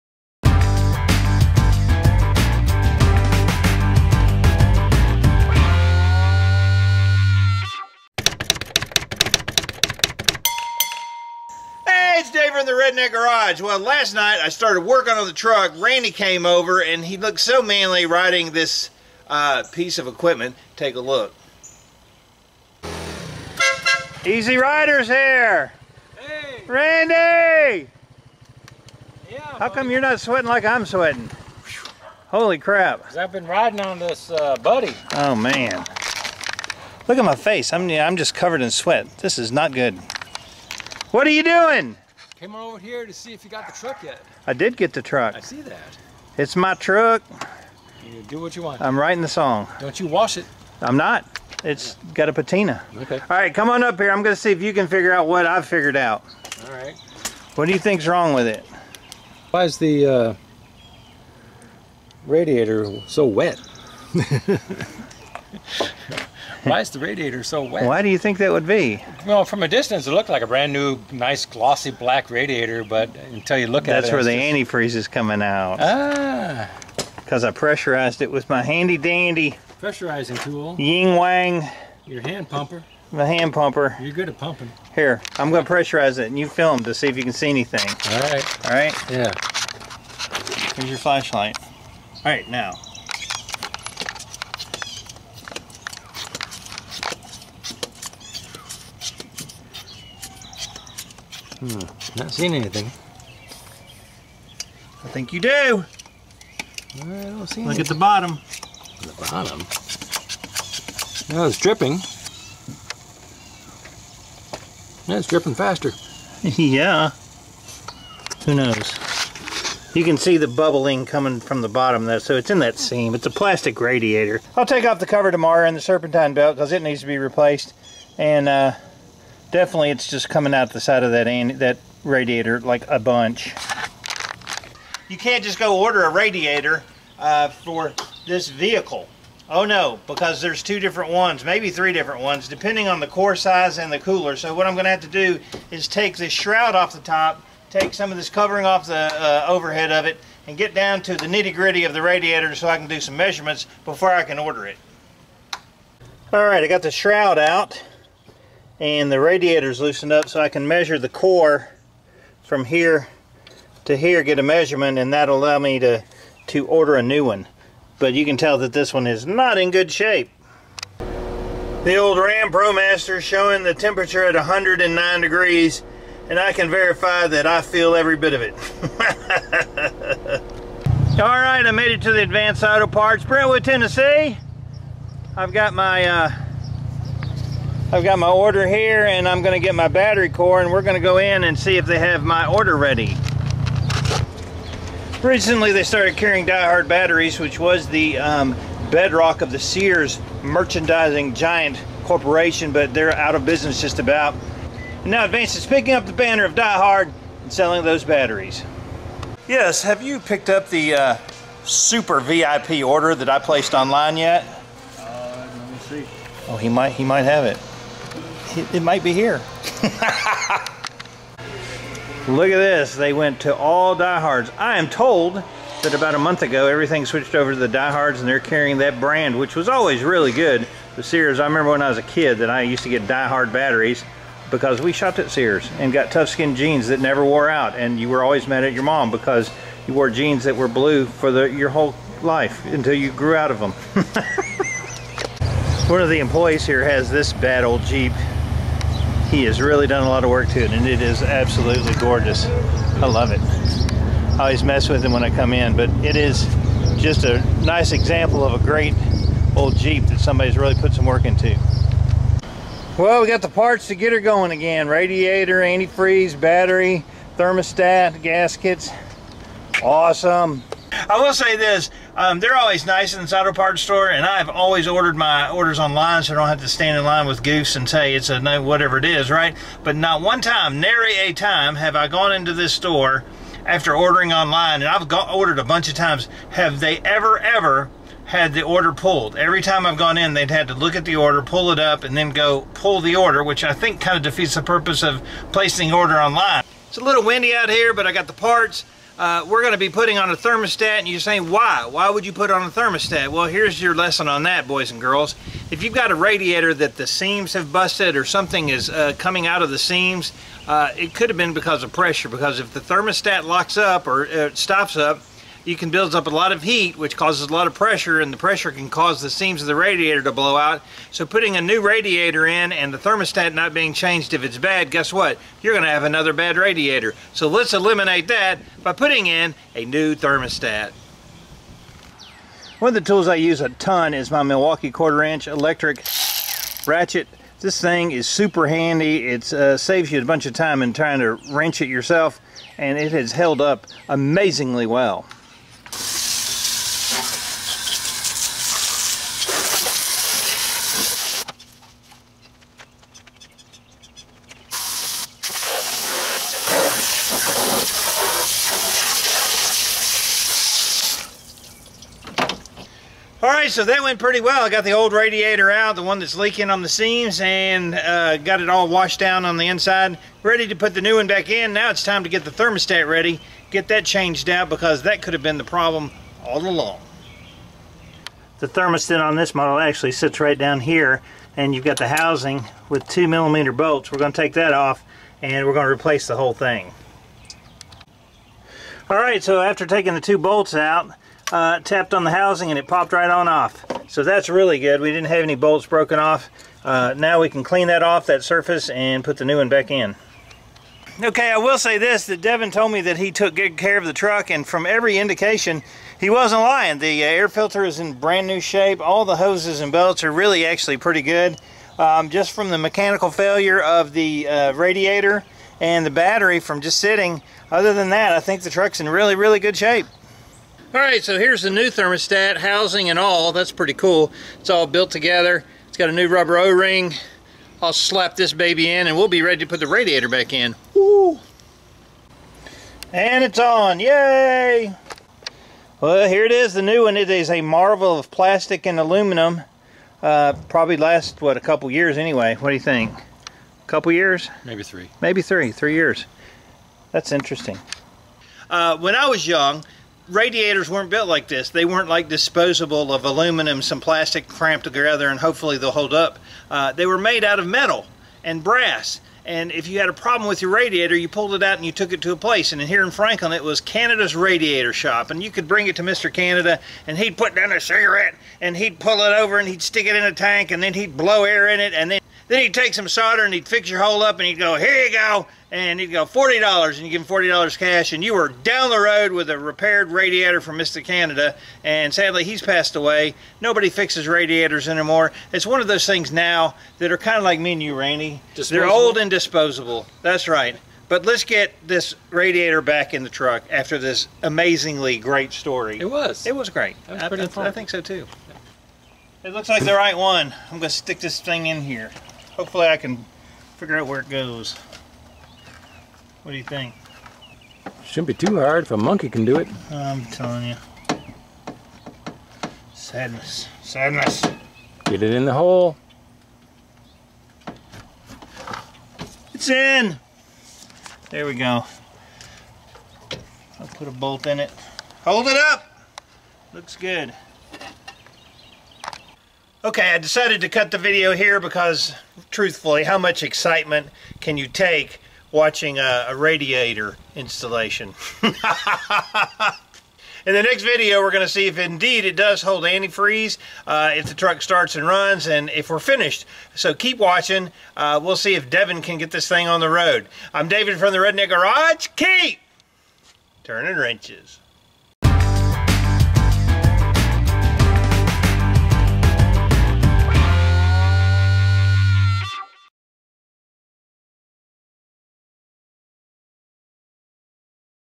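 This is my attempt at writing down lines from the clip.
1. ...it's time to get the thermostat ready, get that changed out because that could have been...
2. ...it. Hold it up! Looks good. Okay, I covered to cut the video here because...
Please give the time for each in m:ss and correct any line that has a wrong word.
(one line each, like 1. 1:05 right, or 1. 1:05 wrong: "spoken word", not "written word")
1. 6:11 right
2. 8:44 wrong: "decided", not "covered".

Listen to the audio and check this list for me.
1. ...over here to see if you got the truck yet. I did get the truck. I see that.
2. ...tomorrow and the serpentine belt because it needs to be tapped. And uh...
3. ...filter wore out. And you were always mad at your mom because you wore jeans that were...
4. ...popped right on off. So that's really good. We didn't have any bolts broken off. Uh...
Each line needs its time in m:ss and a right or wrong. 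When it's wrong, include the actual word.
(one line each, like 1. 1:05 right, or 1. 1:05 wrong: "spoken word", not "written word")
1. 0:42 right
2. 2:05 wrong: "replaced", not "tapped"
3. 3:56 wrong: "never", not "filter"
4. 6:32 right.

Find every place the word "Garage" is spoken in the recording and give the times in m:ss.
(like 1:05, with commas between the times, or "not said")
0:13, 9:11.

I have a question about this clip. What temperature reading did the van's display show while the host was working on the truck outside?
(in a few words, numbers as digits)
109 degrees.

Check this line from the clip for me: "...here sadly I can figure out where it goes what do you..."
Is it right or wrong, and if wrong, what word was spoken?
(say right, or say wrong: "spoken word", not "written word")
wrong: "hopefully", not "sadly".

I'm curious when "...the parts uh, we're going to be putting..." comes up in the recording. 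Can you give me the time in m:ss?
4:58.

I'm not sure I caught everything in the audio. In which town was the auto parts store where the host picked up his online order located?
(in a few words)
Brentwood, Tennessee.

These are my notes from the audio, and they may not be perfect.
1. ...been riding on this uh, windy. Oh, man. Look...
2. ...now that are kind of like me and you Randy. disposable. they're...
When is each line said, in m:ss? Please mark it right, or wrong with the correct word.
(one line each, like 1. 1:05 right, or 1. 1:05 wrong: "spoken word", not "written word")
1. 0:33 wrong: "buddy", not "windy"
2. 8:06 right.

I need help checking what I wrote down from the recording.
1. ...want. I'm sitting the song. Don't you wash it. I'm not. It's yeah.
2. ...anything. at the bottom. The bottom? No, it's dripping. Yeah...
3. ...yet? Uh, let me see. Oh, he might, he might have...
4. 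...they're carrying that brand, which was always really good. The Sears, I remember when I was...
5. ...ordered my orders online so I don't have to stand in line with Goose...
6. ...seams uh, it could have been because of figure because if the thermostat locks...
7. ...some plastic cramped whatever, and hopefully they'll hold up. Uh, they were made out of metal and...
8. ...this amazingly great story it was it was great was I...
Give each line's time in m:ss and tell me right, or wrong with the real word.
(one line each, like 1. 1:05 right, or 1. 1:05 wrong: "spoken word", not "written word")
1. 0:48 wrong: "writing", not "sitting"
2. 1:47 right
3. 3:34 right
4. 3:48 right
5. 4:34 right
6. 5:09 wrong: "pressure", not "figure"
7. 7:33 wrong: "together", not "whatever"
8. 8:13 right.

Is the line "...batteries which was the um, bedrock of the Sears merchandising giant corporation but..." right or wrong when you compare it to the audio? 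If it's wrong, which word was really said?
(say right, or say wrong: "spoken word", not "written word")
right.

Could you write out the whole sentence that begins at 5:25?
You're going to have another bad radiator.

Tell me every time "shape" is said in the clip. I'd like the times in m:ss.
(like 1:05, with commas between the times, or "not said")
2:49, 6:48, 6:59.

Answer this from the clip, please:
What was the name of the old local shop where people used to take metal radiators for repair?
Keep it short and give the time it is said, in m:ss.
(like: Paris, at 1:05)
Canada's Radiator Shop, at 7:43.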